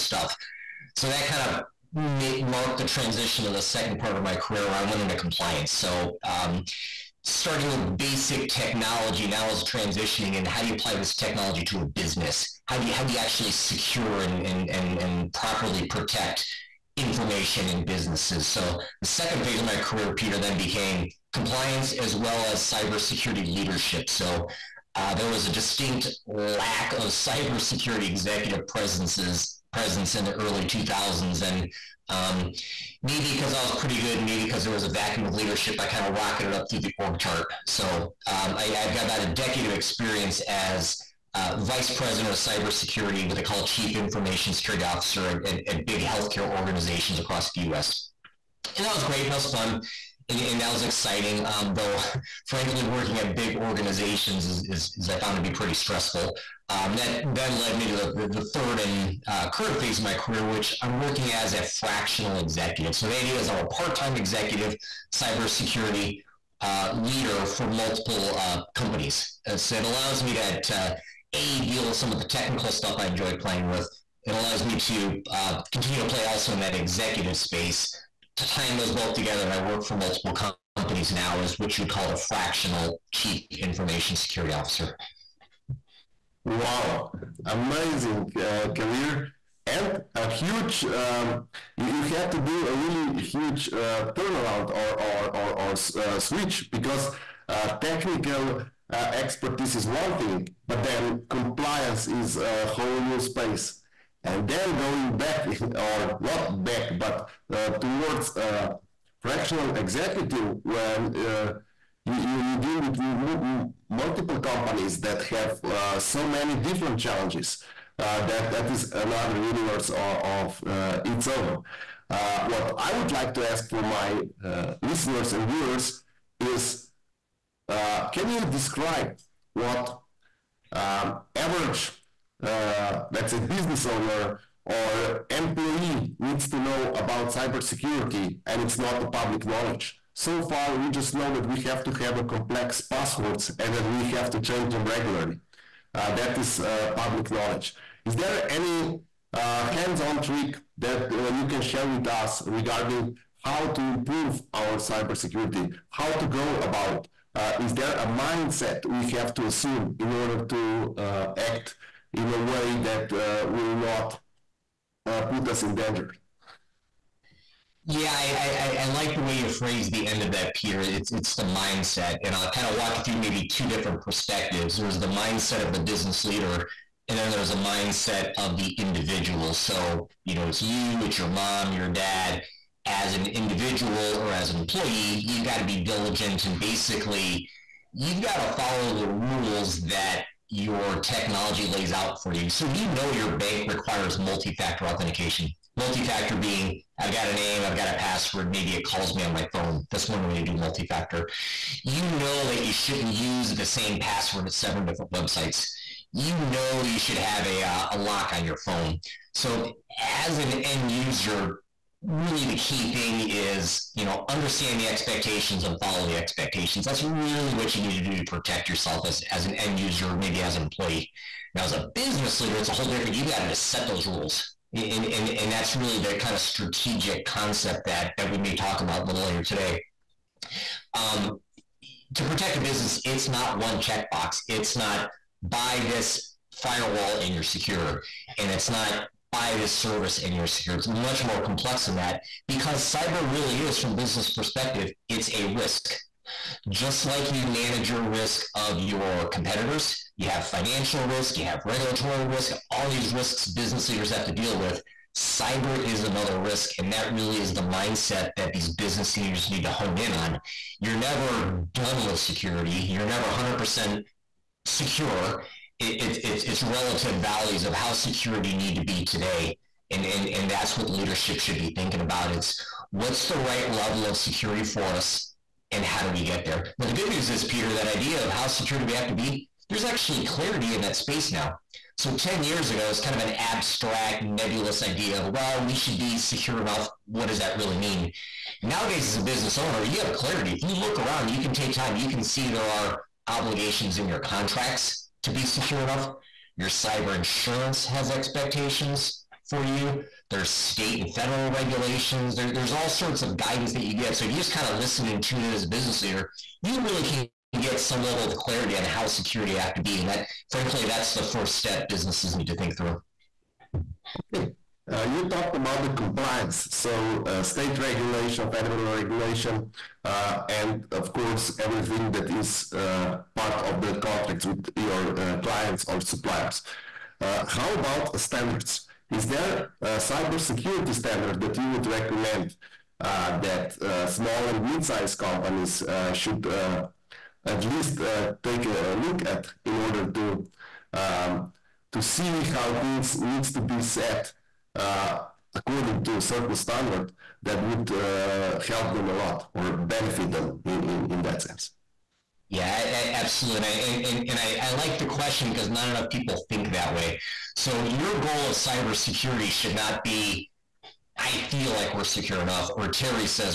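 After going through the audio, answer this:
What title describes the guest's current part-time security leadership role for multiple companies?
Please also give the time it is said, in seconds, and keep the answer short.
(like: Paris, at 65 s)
Fractional chief information security officer, at 82 s.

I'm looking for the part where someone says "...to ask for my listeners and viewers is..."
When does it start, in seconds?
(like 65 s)
123 s.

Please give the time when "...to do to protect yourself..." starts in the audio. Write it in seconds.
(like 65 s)
218 s.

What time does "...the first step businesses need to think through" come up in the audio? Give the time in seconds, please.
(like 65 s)
311 s.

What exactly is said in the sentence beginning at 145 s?
Uh, that is uh, public knowledge.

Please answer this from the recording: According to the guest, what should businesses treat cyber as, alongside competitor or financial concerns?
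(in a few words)
A risk.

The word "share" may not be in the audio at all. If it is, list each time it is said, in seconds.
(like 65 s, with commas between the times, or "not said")
151 s.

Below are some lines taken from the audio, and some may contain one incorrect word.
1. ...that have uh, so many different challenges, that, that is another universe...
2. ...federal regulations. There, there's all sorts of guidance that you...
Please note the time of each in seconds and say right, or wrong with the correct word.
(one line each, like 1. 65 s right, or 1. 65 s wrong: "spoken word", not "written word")
1. 115 s right
2. 301 s right.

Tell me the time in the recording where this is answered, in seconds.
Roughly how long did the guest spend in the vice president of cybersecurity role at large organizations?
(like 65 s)
39 s.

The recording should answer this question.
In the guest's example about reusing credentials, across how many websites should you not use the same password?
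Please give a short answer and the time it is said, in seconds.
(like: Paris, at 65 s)
7, at 204 s.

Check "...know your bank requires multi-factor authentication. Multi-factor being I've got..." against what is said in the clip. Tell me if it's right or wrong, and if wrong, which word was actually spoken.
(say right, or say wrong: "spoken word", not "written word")
right.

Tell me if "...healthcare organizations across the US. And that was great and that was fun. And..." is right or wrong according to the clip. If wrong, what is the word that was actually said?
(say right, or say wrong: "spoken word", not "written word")
right.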